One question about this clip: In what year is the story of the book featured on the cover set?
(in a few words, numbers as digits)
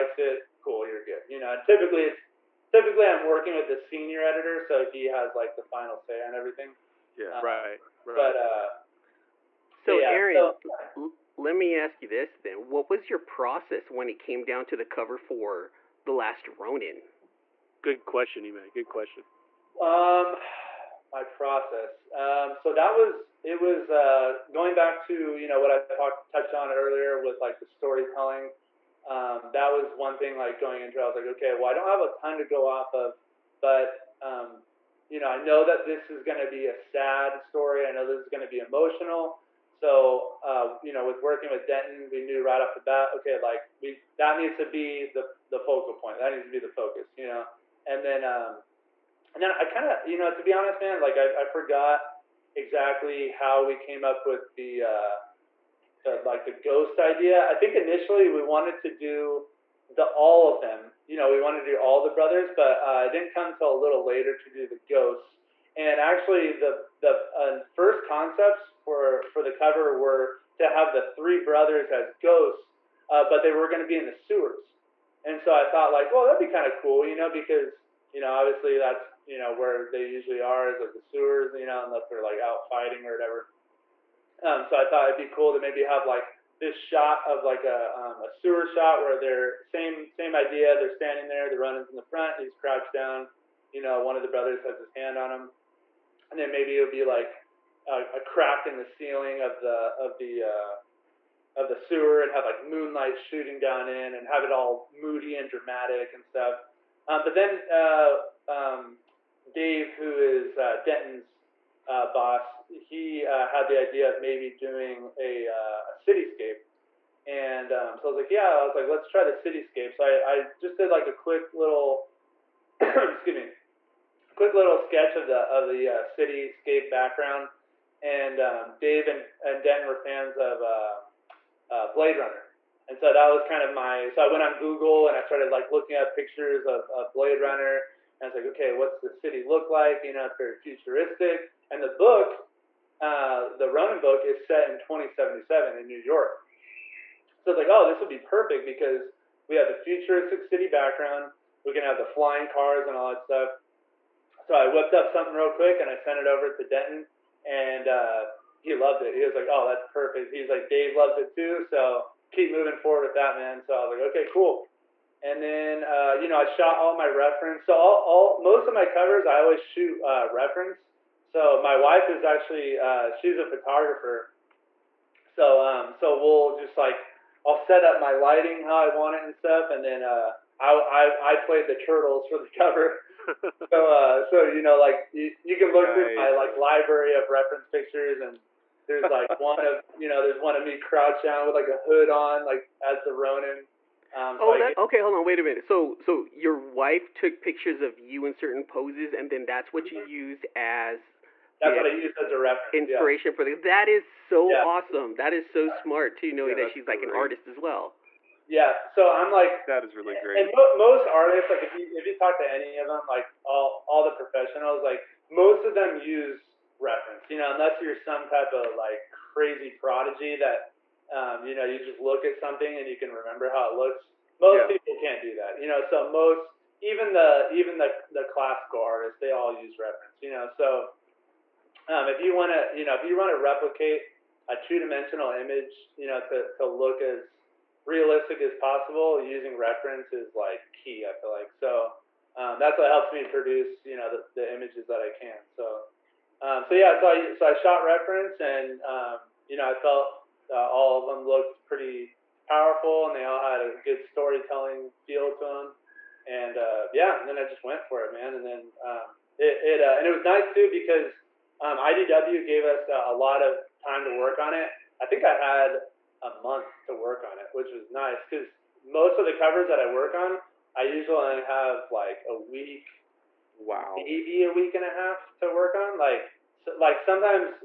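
2077.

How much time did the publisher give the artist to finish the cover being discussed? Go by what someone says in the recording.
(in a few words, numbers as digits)
A month.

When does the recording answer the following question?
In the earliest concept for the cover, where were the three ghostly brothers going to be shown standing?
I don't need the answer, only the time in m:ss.
1:13.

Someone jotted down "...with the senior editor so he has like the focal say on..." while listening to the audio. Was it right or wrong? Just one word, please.
wrong.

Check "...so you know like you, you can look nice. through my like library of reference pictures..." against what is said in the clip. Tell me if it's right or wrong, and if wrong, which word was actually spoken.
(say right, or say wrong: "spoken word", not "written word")
right.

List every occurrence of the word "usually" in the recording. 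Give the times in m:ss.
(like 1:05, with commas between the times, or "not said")
1:20, 4:30.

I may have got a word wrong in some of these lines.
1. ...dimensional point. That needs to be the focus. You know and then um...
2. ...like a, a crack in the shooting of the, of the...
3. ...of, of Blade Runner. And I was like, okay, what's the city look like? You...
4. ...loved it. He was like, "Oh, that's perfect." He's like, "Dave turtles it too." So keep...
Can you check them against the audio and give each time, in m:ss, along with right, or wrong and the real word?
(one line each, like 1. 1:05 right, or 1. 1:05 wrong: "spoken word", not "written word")
1. 0:45 wrong: "focal", not "dimensional"
2. 1:37 wrong: "ceiling", not "shooting"
3. 2:16 right
4. 2:38 wrong: "loves", not "turtles".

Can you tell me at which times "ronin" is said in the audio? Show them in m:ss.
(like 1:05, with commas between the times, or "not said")
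0:16, 1:31, 2:23, 3:13.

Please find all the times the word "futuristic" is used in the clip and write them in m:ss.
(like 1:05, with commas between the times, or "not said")
2:20, 2:29.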